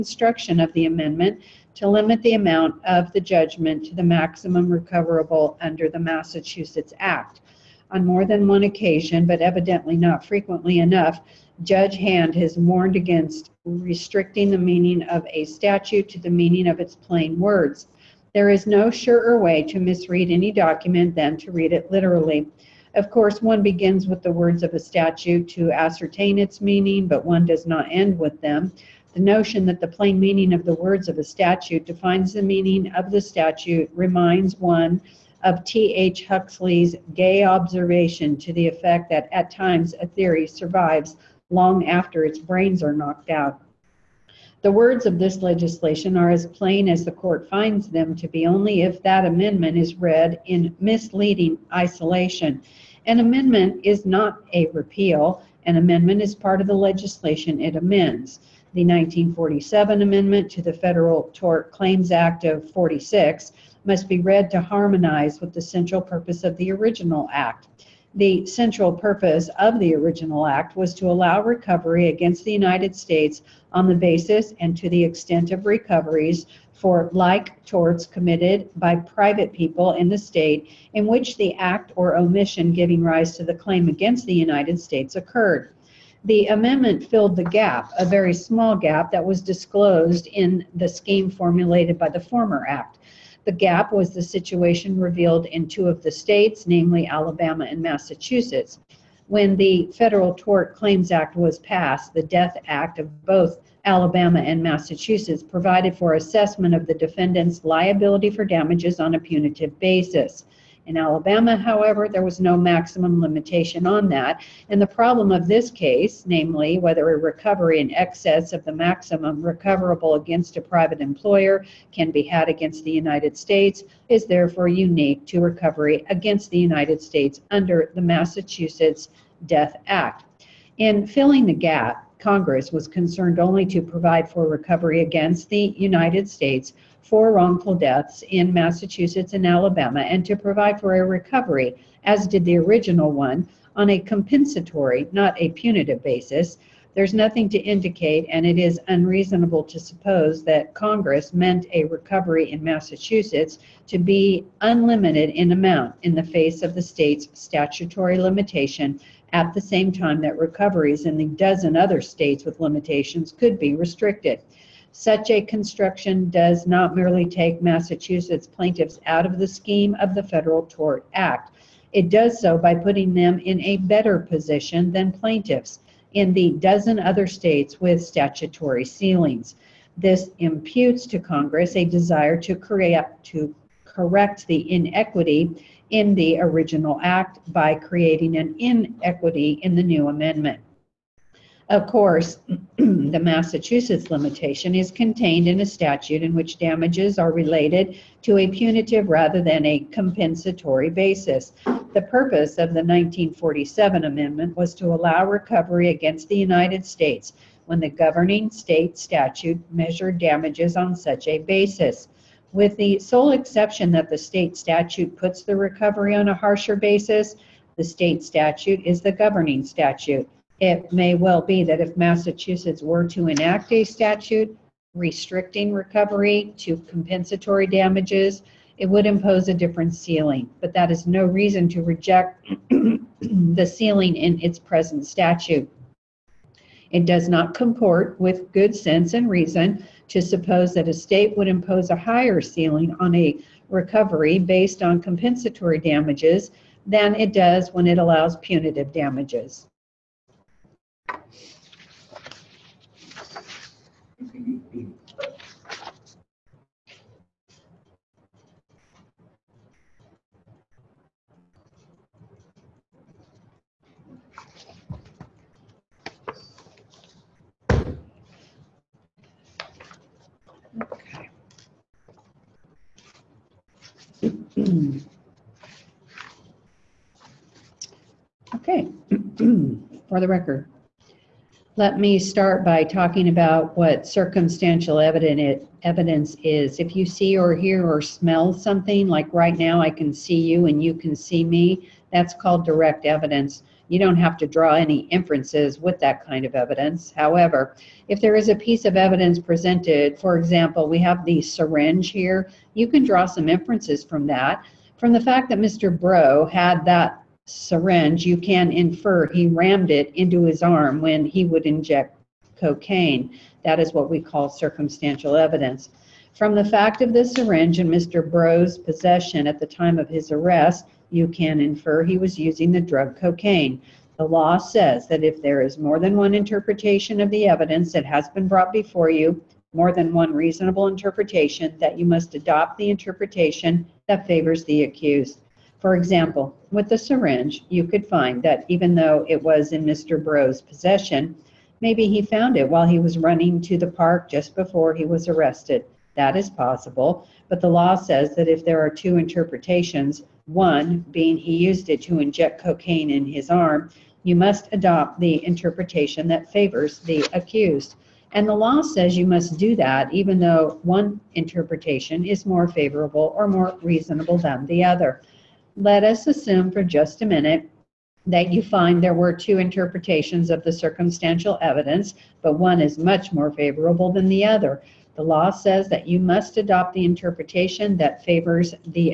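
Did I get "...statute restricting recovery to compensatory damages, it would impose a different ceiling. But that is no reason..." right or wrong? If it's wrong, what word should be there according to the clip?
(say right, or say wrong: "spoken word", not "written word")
right.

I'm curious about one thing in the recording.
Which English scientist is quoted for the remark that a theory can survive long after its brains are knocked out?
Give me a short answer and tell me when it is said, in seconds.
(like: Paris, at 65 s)
T. H. Huxley, at 35 s.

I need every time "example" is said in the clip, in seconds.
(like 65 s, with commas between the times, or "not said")
300 s, 335 s.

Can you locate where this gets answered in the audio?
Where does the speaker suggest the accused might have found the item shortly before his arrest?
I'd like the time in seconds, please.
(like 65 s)
343 s.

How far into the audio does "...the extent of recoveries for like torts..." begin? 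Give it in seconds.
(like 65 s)
74 s.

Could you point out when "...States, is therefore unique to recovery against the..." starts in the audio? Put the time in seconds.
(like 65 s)
123 s.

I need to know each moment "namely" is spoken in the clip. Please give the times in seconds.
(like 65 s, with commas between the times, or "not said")
96 s, 116 s.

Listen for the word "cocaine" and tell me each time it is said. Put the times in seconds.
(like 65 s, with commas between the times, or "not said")
312 s, 323 s, 352 s.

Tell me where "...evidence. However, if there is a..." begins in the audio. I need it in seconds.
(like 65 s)
296 s.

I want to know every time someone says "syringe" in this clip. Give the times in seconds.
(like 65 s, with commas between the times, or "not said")
301 s, 307 s, 317 s, 336 s.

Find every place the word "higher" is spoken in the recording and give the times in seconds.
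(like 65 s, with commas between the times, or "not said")
241 s.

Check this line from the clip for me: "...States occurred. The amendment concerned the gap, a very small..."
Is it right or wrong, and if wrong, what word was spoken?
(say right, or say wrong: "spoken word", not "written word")
wrong: "filled", not "concerned".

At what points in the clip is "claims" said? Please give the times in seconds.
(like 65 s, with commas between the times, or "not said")
61 s, 83 s, 100 s.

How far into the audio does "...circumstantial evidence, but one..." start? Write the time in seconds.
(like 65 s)
370 s.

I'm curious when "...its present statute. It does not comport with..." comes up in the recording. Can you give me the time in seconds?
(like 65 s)
234 s.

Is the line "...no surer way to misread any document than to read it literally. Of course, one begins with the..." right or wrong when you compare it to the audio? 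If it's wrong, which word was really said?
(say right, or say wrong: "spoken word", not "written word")
right.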